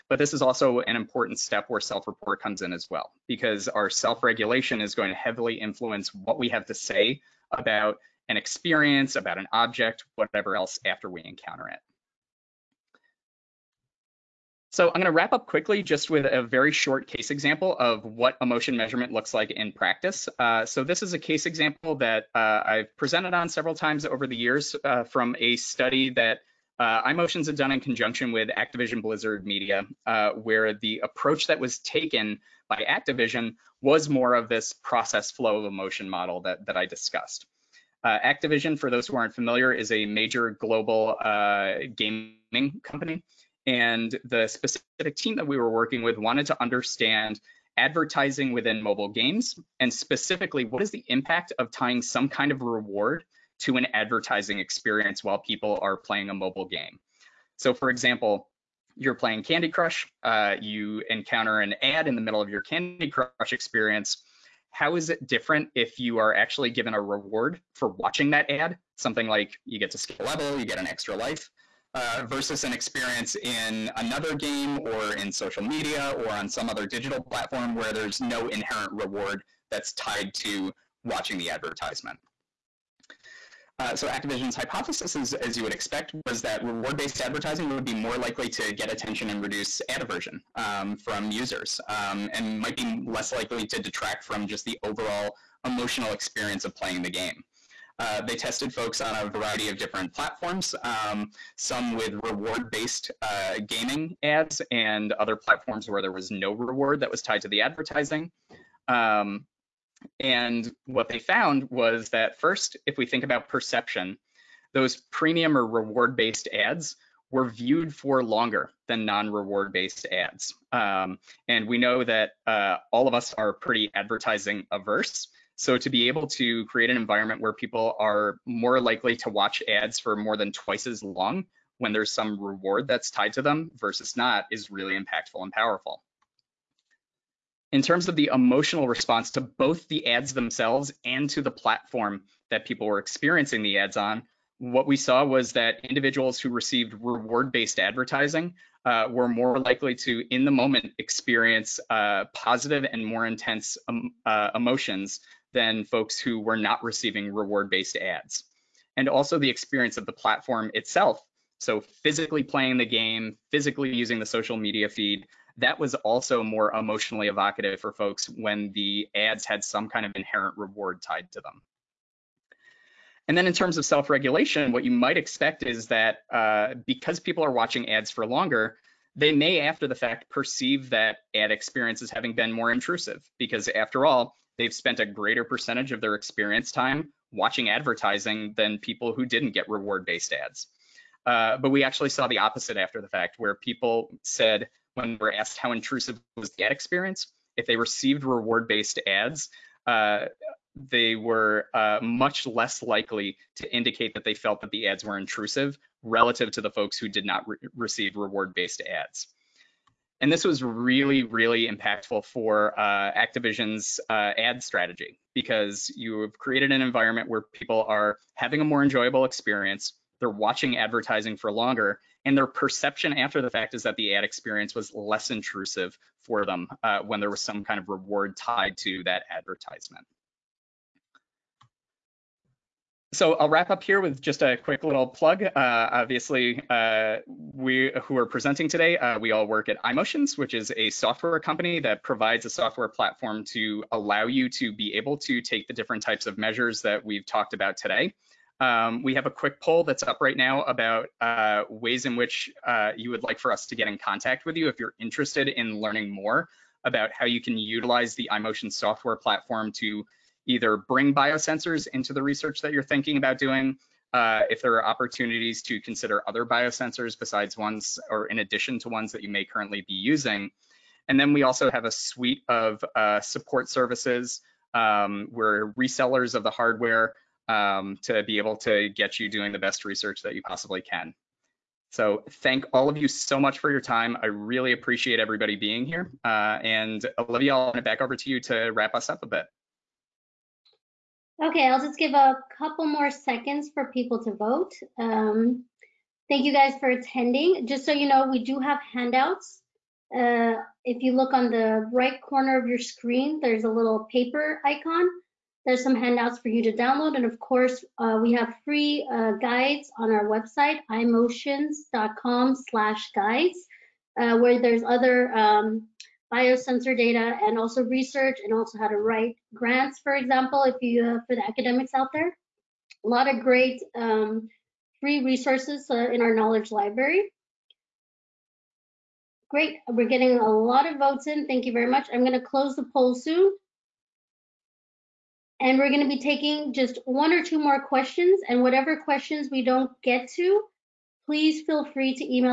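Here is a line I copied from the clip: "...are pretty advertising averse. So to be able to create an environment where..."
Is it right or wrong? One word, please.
right.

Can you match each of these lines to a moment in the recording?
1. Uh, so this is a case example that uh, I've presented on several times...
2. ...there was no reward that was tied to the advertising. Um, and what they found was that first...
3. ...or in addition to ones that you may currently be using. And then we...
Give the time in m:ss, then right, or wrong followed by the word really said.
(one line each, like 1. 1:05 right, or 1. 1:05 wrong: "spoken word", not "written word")
1. 0:20 right
2. 1:46 right
3. 4:28 right.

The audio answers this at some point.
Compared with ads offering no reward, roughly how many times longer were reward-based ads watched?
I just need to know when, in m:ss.
2:10.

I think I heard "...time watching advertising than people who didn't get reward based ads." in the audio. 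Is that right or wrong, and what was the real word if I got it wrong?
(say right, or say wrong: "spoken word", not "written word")
right.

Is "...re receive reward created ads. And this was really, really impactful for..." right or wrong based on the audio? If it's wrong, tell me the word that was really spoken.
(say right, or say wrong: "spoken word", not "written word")
wrong: "based", not "created".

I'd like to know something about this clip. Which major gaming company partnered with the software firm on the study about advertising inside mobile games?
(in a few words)
Activision Blizzard Media.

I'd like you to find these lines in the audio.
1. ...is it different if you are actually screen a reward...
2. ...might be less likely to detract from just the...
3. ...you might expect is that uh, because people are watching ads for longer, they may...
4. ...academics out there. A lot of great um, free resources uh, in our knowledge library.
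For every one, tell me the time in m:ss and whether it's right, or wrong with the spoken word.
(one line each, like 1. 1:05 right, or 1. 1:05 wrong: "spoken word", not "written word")
1. 1:04 wrong: "given", not "screen"
2. 1:32 right
3. 2:54 right
4. 5:21 right.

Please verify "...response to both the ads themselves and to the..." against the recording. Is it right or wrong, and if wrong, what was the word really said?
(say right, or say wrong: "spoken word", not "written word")
right.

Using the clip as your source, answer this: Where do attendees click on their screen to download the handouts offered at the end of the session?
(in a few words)
paper icon.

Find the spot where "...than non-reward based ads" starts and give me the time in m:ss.
1:58.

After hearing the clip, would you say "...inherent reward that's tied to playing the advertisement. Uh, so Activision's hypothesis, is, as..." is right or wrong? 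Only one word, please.
wrong.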